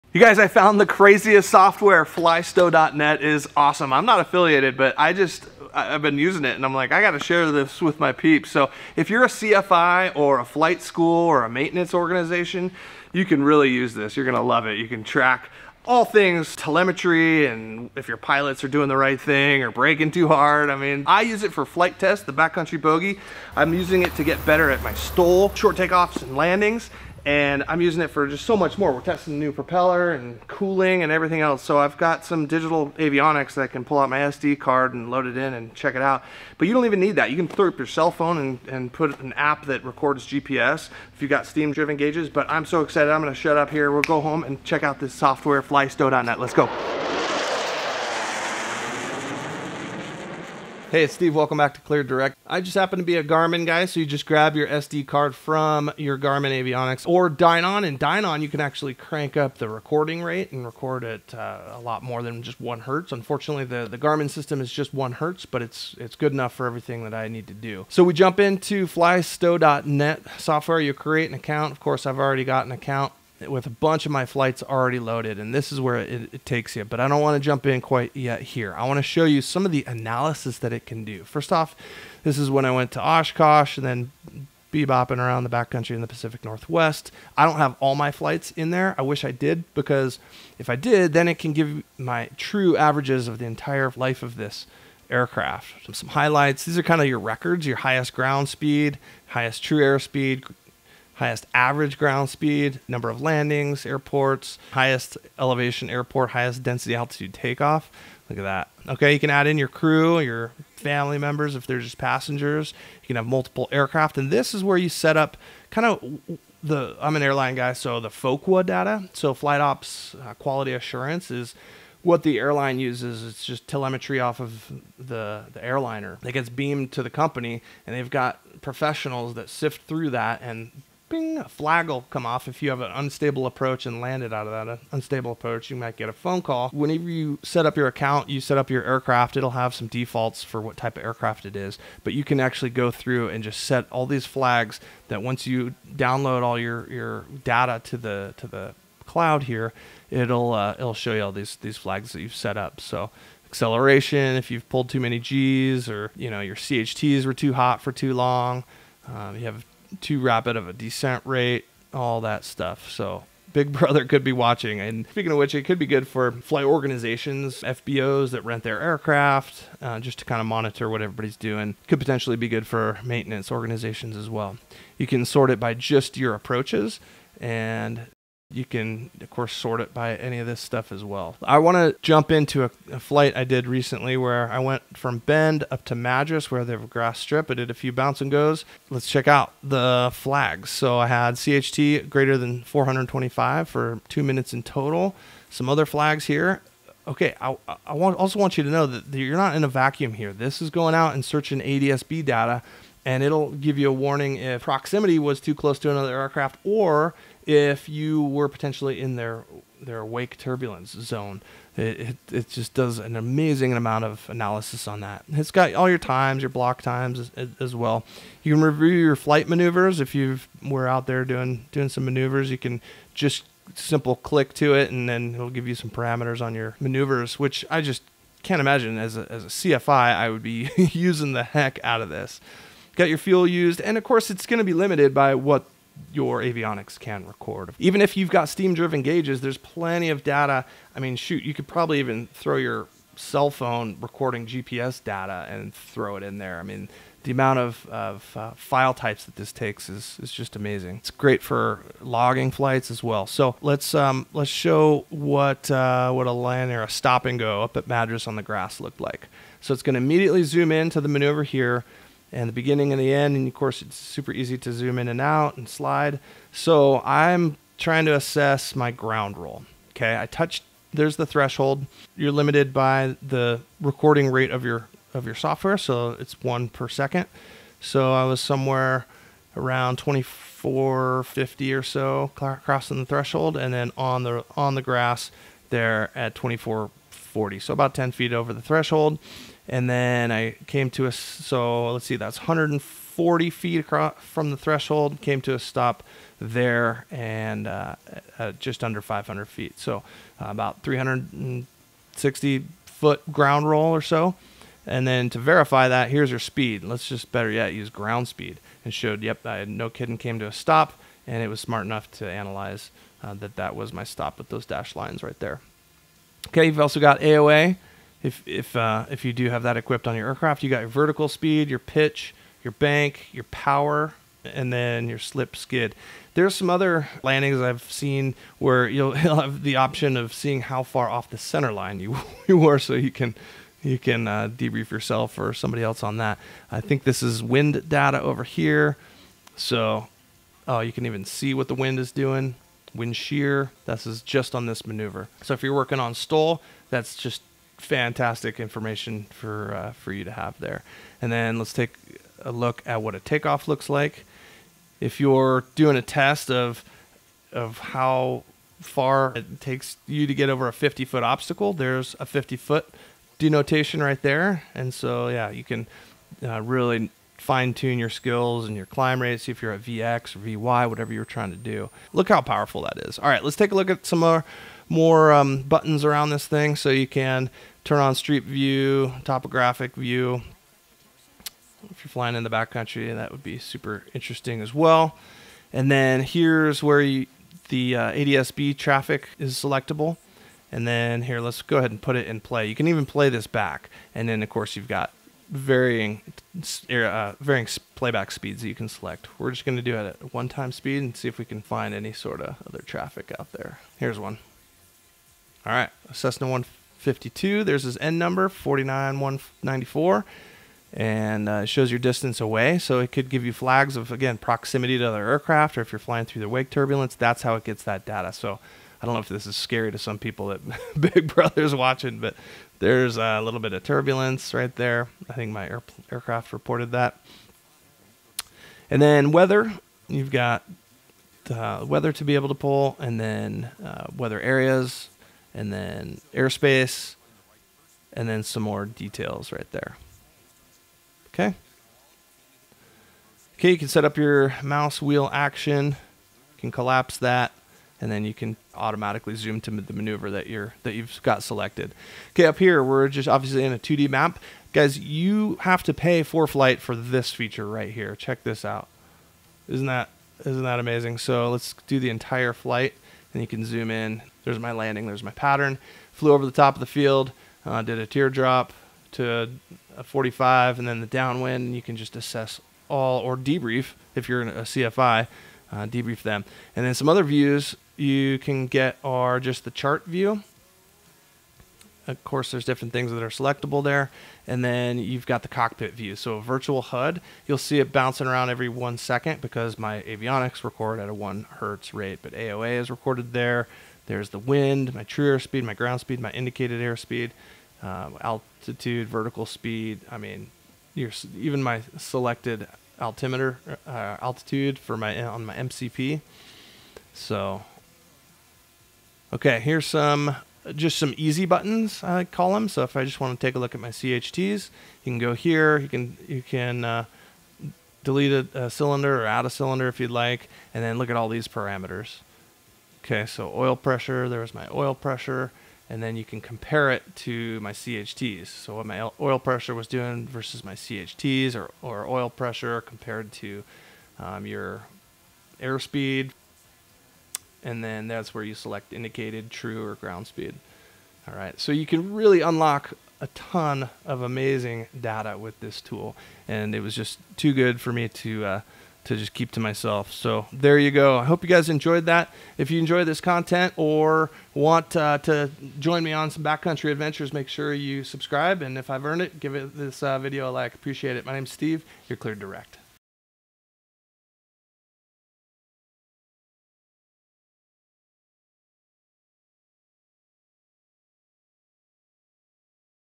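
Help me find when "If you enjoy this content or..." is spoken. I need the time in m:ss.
9:12.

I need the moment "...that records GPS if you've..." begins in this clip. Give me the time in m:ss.
0:39.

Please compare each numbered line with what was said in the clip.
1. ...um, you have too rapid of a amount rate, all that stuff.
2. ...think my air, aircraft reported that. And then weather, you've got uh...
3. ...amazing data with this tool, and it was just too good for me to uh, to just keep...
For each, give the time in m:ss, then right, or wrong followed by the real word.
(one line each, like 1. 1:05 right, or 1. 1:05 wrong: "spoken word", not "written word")
1. 2:39 wrong: "descent", not "amount"
2. 7:05 right
3. 9:04 right.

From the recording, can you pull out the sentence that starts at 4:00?
I mean, shoot, you could probably even throw your cell phone recording GPS data and throw it in there.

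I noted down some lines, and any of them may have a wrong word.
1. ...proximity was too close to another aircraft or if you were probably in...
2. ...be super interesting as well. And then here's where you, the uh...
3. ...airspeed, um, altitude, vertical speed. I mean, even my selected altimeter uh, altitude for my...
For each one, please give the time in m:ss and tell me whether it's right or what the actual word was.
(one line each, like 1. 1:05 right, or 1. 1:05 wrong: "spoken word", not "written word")
1. 3:24 wrong: "potentially", not "probably"
2. 6:23 right
3. 8:16 right.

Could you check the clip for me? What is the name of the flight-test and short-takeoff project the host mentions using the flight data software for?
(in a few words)
backcountry bogey.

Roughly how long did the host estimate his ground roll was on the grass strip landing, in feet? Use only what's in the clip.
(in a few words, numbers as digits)
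360 feet.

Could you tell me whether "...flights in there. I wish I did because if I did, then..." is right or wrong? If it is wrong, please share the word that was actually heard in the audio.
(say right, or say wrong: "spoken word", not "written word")
right.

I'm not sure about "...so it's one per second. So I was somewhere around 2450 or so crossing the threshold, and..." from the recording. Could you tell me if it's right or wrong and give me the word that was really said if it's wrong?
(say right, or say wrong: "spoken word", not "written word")
right.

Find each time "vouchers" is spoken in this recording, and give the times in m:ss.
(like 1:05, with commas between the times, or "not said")
not said.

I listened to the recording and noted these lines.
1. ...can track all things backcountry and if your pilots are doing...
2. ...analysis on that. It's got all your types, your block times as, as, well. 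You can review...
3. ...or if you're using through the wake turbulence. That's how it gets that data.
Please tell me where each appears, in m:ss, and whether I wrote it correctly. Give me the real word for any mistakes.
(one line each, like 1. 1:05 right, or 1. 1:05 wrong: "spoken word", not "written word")
1. 0:14 wrong: "telemetry", not "backcountry"
2. 3:34 wrong: "times", not "types"
3. 6:55 wrong: "flying", not "using".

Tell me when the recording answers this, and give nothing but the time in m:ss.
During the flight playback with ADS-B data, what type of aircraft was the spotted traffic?
6:46.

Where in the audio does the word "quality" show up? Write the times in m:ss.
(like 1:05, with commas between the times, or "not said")
2:00.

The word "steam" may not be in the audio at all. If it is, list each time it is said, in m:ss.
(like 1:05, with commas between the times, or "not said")
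0:41, 3:58.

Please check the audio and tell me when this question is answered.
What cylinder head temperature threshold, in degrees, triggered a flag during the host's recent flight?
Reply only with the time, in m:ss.
3:12.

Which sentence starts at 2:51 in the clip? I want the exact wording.
Could potentially be good for maintenance organizations as well.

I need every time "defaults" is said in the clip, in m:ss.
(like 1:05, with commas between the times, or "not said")
2:19.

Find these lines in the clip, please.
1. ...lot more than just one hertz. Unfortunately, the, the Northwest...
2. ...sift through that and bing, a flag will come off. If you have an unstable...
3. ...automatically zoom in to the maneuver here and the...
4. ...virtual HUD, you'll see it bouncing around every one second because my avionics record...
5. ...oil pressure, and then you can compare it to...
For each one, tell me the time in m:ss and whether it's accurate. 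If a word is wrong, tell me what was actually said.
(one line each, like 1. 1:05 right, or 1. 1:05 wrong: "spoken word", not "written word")
1. 1:01 wrong: "Garmin", not "Northwest"
2. 2:09 right
3. 4:19 wrong: "immediately", not "automatically"
4. 8:06 right
5. 8:44 right.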